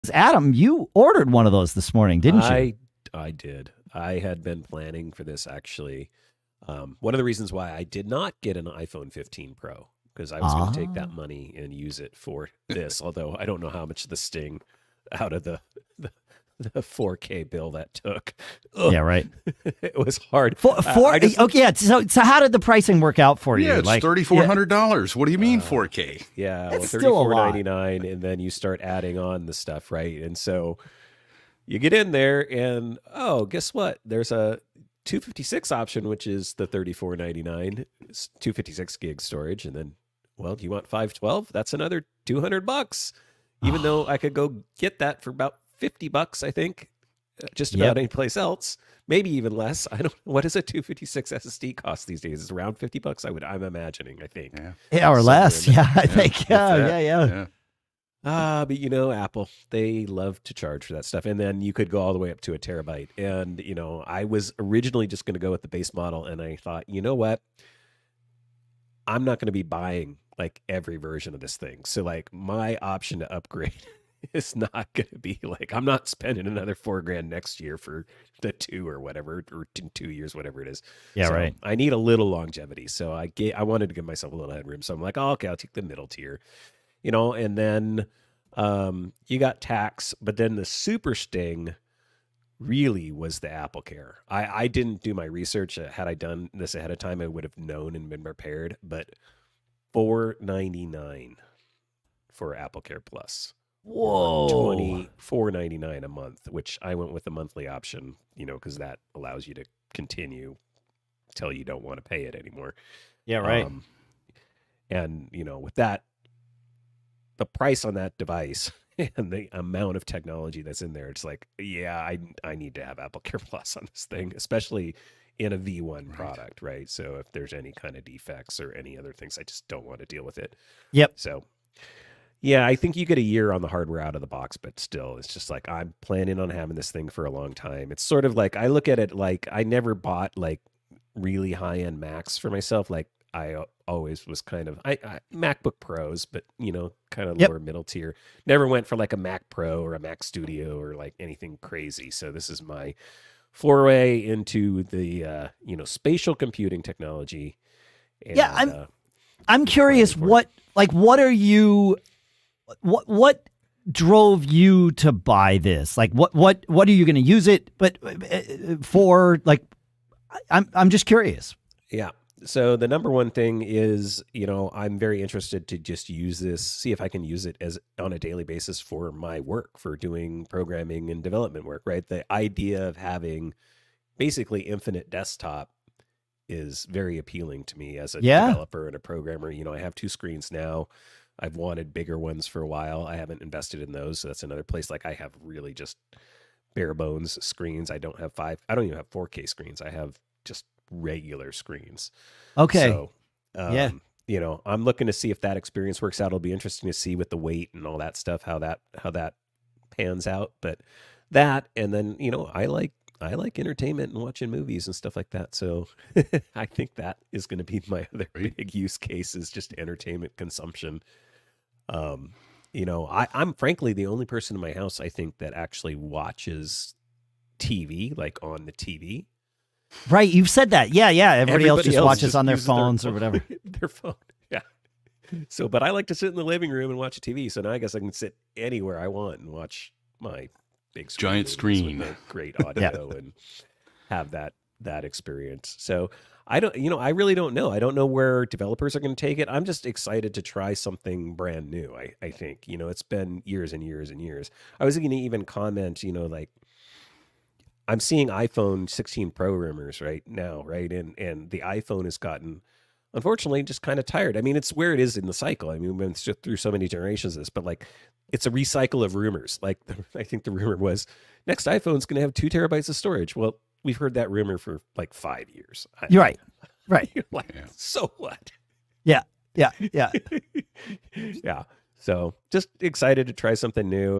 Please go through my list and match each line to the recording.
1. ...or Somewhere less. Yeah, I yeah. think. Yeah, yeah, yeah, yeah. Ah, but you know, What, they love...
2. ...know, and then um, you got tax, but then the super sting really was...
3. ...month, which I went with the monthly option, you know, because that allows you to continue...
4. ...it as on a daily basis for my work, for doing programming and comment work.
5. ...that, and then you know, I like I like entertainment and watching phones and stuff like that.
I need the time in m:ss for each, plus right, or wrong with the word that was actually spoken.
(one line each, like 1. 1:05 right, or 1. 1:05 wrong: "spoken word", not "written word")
1. 0:55 wrong: "Apple", not "What"
2. 1:27 right
3. 1:46 right
4. 2:57 wrong: "development", not "comment"
5. 3:31 wrong: "movies", not "phones".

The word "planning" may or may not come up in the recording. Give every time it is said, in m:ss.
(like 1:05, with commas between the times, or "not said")
0:04, 2:16.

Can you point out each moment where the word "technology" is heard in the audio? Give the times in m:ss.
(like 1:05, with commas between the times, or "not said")
2:00, 2:36.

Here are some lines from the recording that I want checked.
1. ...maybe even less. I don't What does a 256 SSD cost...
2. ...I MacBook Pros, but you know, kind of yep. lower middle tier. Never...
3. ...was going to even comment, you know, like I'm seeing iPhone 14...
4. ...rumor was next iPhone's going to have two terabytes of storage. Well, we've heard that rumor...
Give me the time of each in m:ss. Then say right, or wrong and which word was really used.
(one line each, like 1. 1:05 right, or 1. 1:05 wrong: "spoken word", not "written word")
1. 0:49 right
2. 2:25 right
3. 4:14 wrong: "16", not "14"
4. 4:30 right.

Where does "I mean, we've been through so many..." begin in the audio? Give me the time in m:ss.
4:25.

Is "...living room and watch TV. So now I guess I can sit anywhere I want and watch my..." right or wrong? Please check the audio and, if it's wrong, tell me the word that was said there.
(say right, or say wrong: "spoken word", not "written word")
right.